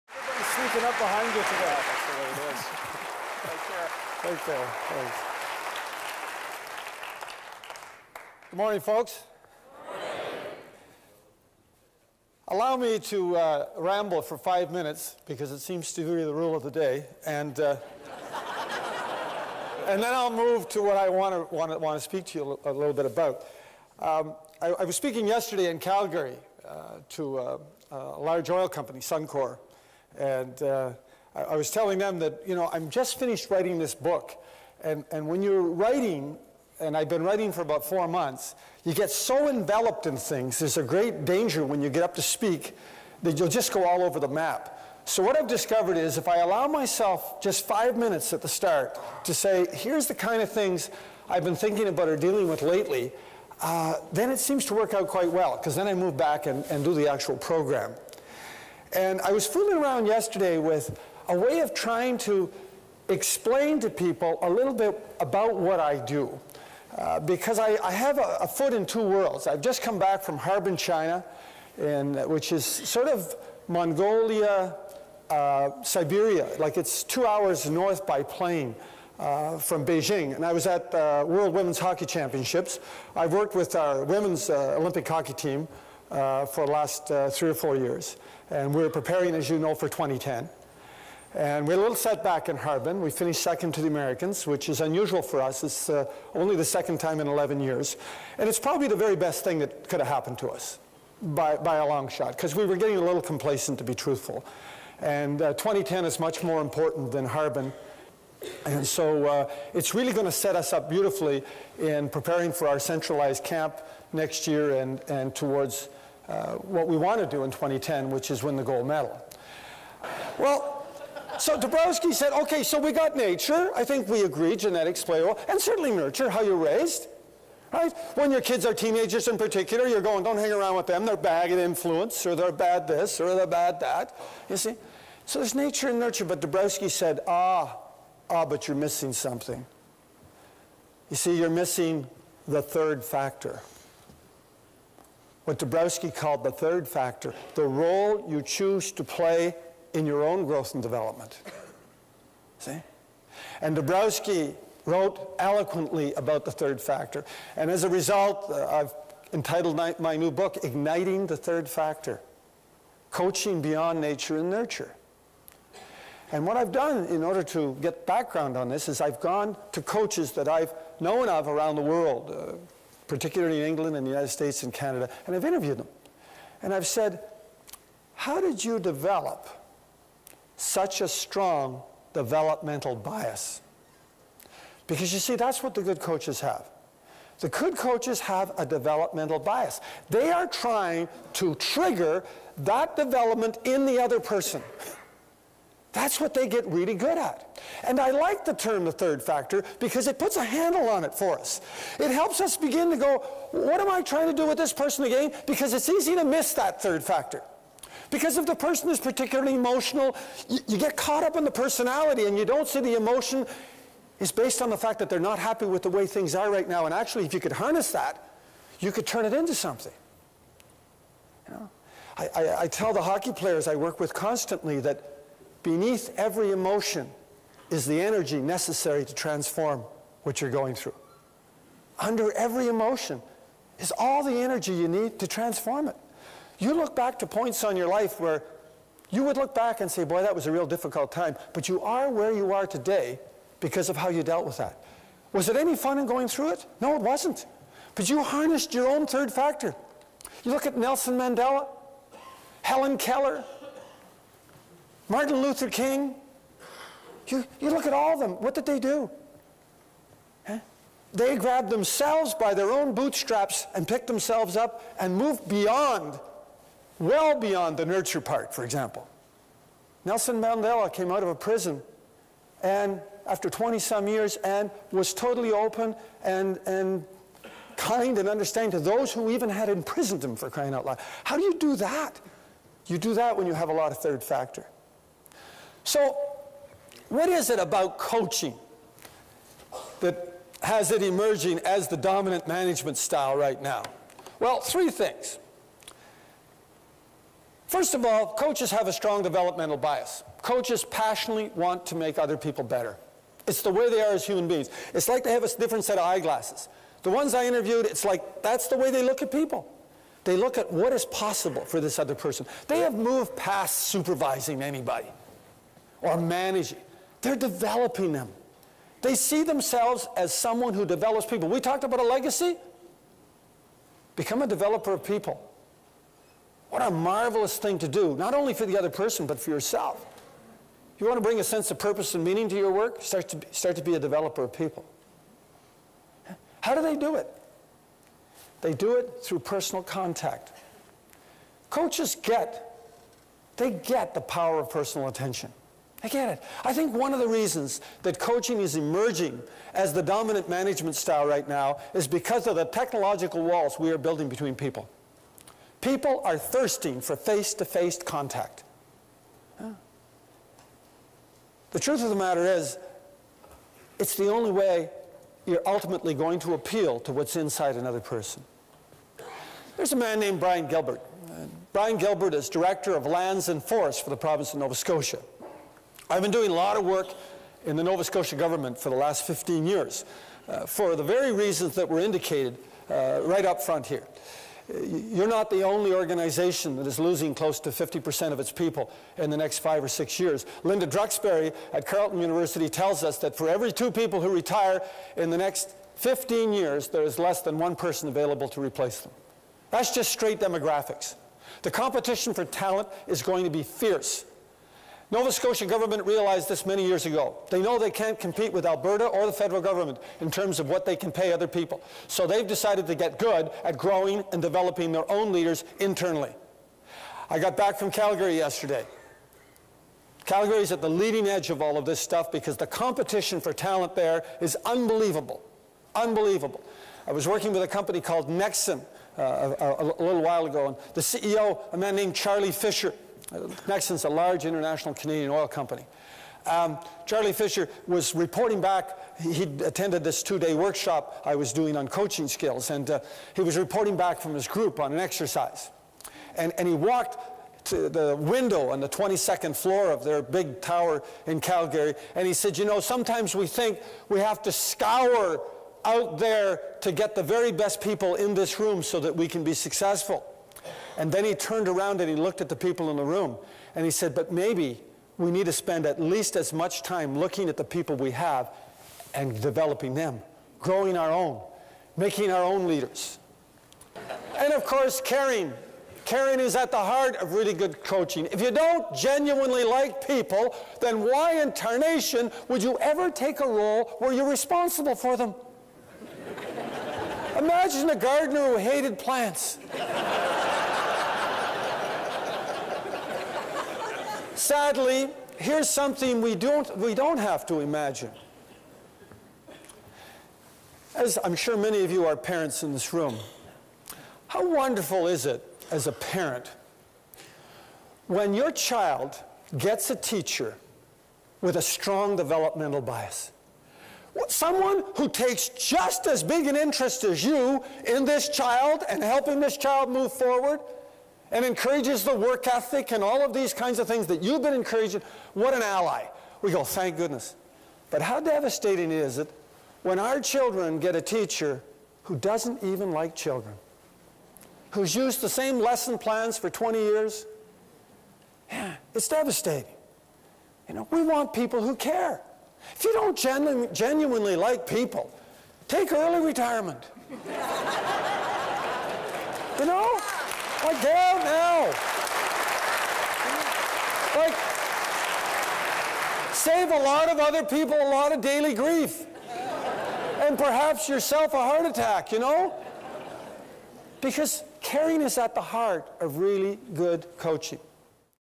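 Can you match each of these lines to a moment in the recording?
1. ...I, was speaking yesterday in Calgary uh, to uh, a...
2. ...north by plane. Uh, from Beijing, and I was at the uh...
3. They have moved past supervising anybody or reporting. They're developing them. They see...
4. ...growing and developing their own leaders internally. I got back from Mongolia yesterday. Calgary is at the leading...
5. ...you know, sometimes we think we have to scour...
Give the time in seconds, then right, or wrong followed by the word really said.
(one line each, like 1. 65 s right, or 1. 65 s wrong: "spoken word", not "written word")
1. 24 s right
2. 77 s right
3. 312 s wrong: "managing", not "reporting"
4. 413 s wrong: "Calgary", not "Mongolia"
5. 452 s right.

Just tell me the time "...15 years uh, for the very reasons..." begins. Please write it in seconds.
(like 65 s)
379 s.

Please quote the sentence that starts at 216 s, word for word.
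And actually, if you could harness that, you could turn it into something.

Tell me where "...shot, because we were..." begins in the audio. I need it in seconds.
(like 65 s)
102 s.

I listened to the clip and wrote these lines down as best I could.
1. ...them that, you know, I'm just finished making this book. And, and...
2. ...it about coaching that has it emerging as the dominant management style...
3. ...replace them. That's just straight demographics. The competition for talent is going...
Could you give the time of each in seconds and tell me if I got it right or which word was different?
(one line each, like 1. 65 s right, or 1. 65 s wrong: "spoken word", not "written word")
1. 31 s wrong: "writing", not "making"
2. 287 s right
3. 398 s right.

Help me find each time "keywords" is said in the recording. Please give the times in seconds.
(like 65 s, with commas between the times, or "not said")
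not said.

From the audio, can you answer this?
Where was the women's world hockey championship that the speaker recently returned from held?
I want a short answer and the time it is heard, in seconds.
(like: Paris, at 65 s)
Harbin, China, at 70 s.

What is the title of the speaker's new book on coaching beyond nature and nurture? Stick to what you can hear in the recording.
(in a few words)
Igniting the Third Factor.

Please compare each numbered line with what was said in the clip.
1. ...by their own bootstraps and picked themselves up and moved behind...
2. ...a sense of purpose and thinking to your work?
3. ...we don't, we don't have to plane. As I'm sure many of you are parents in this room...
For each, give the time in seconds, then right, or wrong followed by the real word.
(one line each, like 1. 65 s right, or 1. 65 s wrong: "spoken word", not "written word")
1. 262 s wrong: "beyond", not "behind"
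2. 331 s wrong: "meaning", not "thinking"
3. 496 s wrong: "imagine", not "plane".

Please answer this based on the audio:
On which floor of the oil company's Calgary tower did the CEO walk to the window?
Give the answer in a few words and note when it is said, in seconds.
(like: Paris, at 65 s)
22nd floor, at 448 s.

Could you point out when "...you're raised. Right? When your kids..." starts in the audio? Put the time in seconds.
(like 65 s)
126 s.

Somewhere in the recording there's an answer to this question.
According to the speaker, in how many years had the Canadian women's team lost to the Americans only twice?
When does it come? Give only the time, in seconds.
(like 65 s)
97 s.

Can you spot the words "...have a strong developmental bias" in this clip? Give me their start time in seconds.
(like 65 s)
298 s.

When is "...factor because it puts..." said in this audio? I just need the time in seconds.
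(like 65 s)
199 s.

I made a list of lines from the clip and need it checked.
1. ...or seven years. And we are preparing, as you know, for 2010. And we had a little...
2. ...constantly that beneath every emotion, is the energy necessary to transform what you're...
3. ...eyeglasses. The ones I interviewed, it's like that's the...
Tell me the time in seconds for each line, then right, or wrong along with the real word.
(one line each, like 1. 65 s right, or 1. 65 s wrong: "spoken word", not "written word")
1. 87 s wrong: "four", not "seven"
2. 224 s right
3. 306 s right.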